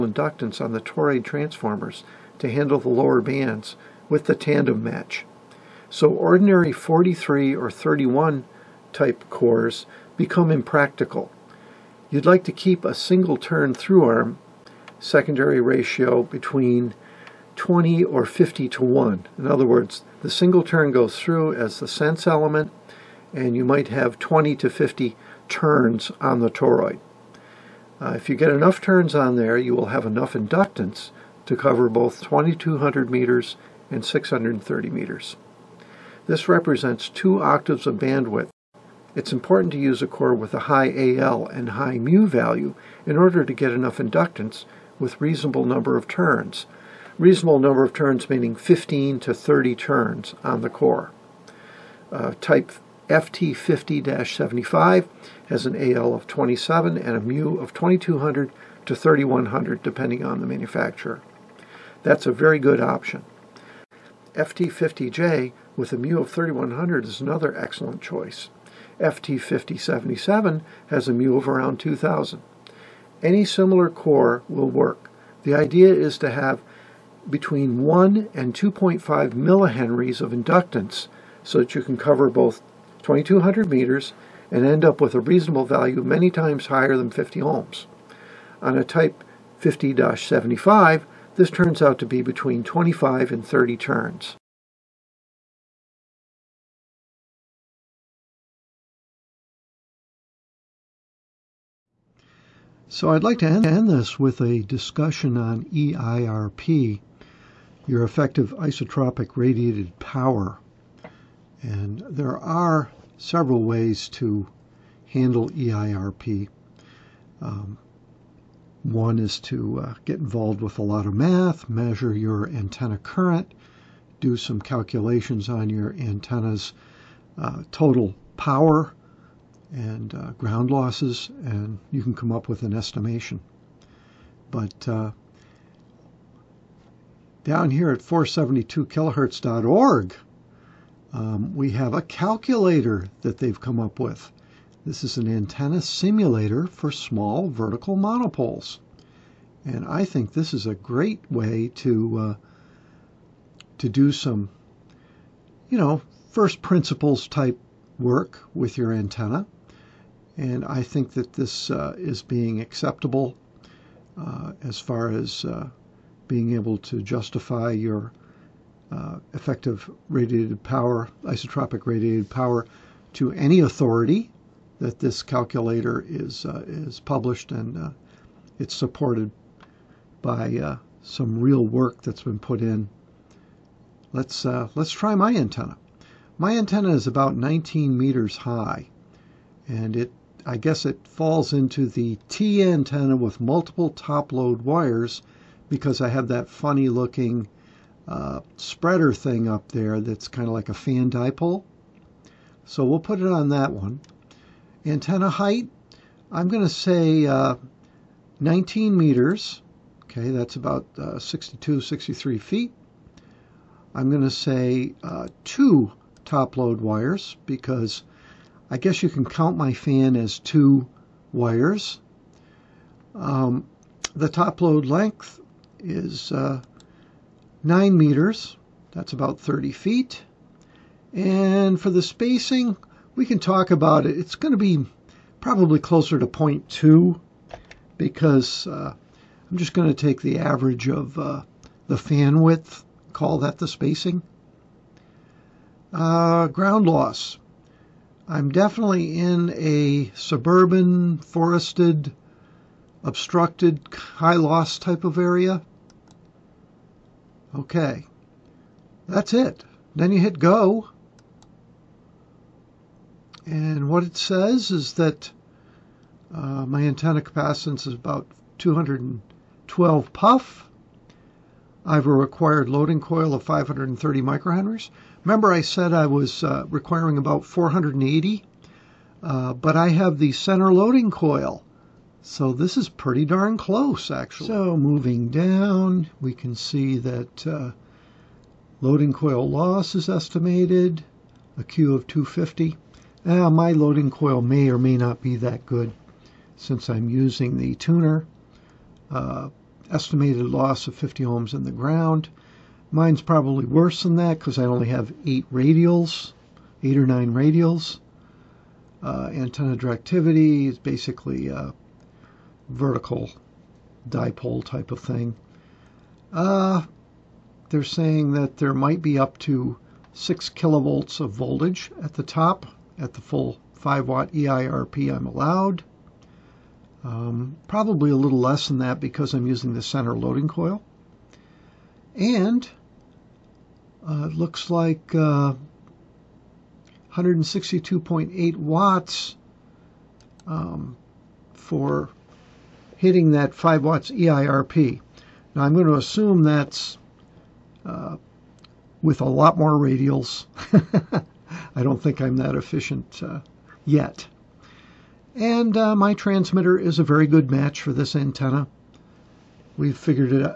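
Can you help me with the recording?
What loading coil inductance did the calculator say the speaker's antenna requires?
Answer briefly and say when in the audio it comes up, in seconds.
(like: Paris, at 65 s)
530 microhenries, at 273 s.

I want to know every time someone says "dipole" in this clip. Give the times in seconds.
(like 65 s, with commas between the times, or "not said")
201 s, 314 s.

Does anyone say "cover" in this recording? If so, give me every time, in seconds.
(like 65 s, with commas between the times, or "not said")
31 s, 81 s.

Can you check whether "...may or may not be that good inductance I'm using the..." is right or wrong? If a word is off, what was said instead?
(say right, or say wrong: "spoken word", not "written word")
wrong: "since", not "inductance".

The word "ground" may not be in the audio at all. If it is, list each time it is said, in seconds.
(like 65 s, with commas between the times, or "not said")
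130 s, 246 s, 301 s.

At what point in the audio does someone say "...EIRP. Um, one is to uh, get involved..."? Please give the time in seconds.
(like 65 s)
115 s.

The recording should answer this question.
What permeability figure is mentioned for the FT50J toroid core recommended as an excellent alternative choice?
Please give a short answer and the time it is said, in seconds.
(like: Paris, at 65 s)
3100, at 64 s.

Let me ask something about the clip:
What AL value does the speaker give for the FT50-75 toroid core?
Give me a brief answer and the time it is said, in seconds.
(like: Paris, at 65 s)
27, at 55 s.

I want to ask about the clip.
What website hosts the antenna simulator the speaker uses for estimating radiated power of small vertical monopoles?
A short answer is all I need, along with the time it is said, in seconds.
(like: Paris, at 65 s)
472kilohertz.org, at 137 s.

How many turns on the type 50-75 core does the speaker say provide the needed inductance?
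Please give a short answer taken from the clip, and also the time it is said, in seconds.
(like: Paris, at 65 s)
25 to 30 turns, at 92 s.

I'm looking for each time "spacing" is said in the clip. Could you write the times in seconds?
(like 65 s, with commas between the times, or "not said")
232 s, 243 s.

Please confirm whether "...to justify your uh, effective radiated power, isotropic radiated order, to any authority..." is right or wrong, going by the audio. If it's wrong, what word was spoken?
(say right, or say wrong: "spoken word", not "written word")
wrong: "power", not "order".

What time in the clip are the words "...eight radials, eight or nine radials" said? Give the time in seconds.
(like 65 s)
305 s.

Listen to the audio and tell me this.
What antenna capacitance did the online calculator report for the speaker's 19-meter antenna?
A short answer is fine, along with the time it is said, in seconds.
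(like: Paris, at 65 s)
212 pF, at 268 s.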